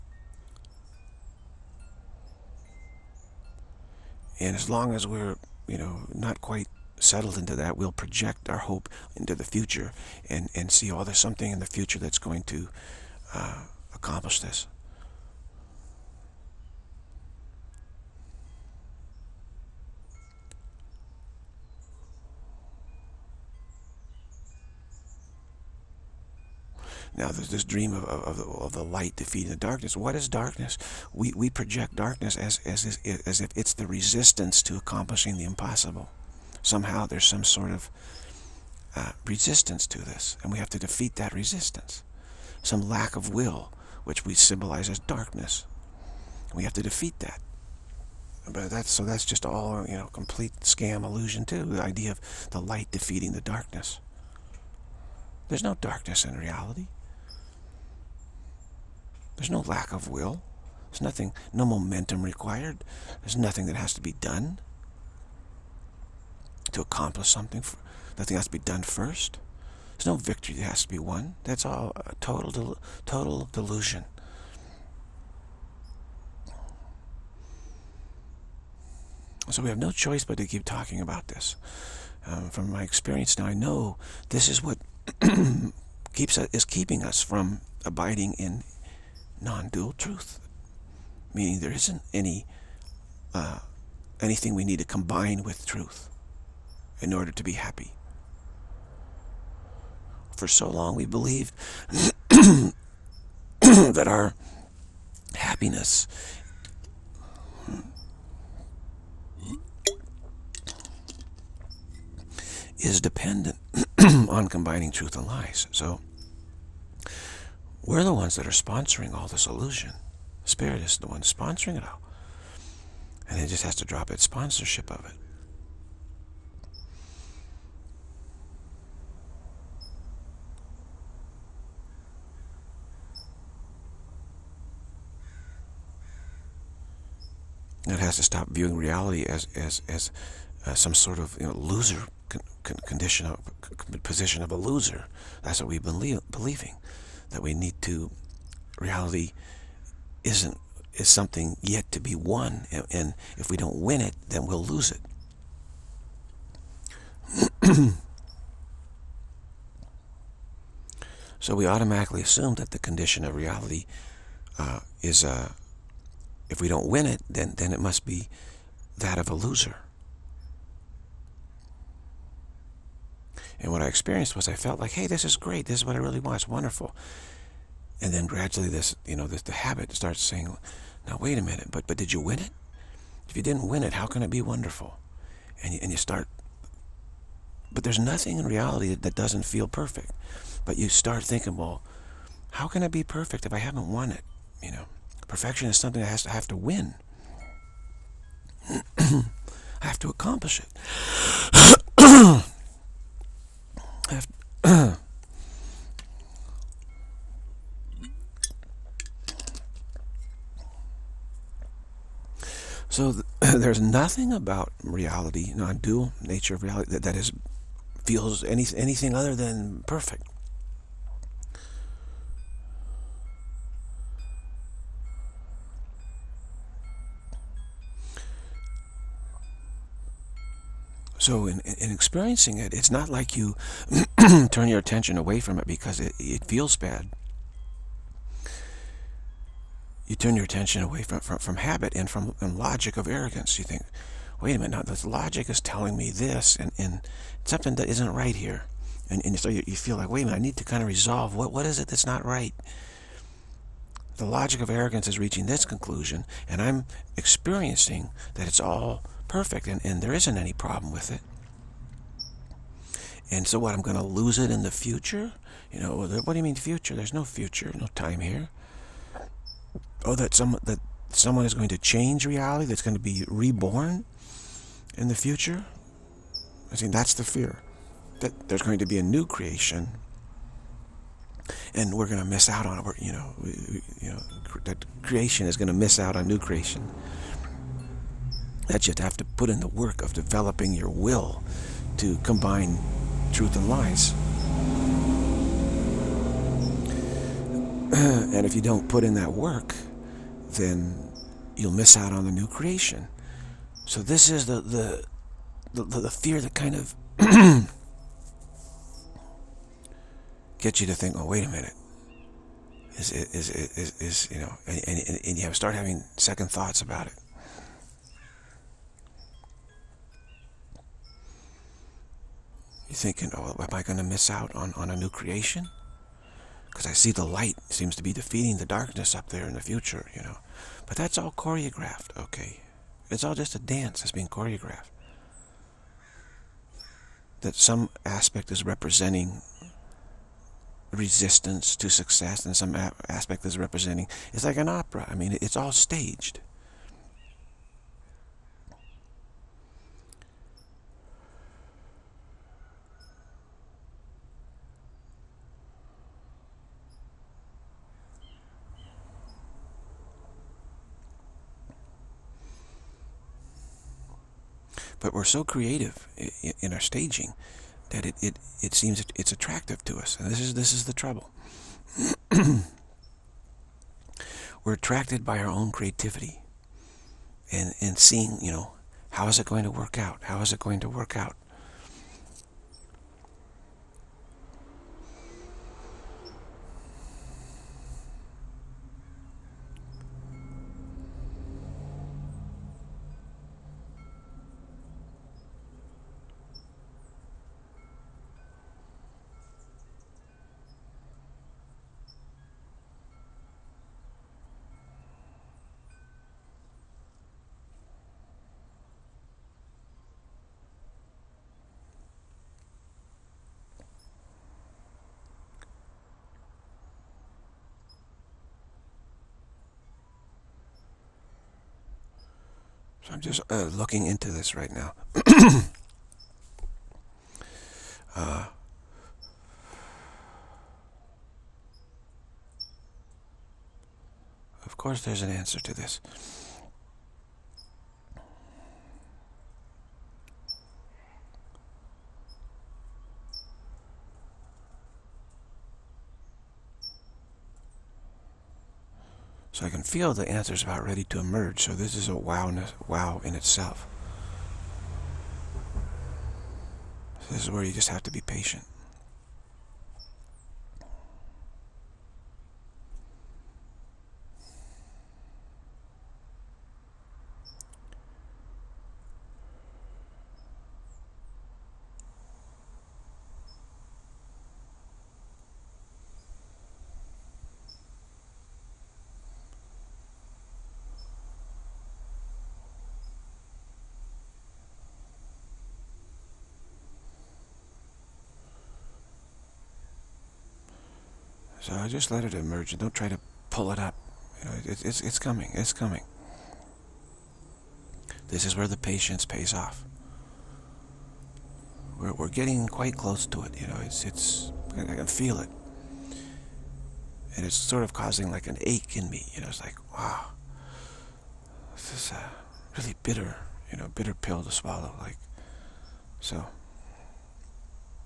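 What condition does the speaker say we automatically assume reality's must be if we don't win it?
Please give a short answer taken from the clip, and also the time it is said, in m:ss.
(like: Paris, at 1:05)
that of a loser, at 2:48.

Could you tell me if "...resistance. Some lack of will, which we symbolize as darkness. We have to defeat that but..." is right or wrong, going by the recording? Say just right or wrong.
right.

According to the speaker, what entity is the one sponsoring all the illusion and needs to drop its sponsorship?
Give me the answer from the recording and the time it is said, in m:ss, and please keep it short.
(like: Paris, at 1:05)
Spirit, at 2:00.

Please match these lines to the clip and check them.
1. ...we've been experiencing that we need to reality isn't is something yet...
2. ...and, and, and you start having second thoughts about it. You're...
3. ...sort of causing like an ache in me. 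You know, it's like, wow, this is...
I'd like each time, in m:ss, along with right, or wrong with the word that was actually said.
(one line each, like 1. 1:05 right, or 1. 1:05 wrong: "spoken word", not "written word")
1. 2:25 wrong: "believing", not "experiencing"
2. 5:14 right
3. 8:27 right.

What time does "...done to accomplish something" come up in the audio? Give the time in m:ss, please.
1:04.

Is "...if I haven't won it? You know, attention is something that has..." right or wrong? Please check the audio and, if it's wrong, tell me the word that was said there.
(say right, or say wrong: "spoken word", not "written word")
wrong: "perfection", not "attention".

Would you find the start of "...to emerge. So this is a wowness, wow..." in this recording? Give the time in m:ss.
7:31.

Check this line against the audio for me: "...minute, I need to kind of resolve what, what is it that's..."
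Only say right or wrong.
right.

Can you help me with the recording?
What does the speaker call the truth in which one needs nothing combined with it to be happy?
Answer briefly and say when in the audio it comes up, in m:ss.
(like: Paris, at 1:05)
non-dual truth, at 1:29.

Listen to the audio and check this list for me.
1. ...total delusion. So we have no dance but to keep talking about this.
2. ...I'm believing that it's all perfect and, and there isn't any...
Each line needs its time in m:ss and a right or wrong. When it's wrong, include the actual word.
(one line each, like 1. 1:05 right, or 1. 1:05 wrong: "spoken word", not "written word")
1. 1:13 wrong: "choice", not "dance"
2. 4:16 wrong: "experiencing", not "believing".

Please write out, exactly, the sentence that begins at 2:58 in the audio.
And then gradually this, you know, this, the habit starts saying, now wait a minute, but, but did you win it?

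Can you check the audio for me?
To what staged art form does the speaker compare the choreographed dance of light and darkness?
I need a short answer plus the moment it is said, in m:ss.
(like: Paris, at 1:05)
opera, at 5:44.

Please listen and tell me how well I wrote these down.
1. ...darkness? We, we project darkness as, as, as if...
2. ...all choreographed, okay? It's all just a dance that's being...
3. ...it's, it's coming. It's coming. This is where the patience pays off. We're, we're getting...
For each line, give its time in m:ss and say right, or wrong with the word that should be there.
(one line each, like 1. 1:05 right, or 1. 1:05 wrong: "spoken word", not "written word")
1. 0:30 right
2. 5:31 right
3. 8:14 right.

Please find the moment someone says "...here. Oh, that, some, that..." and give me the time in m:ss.
4:28.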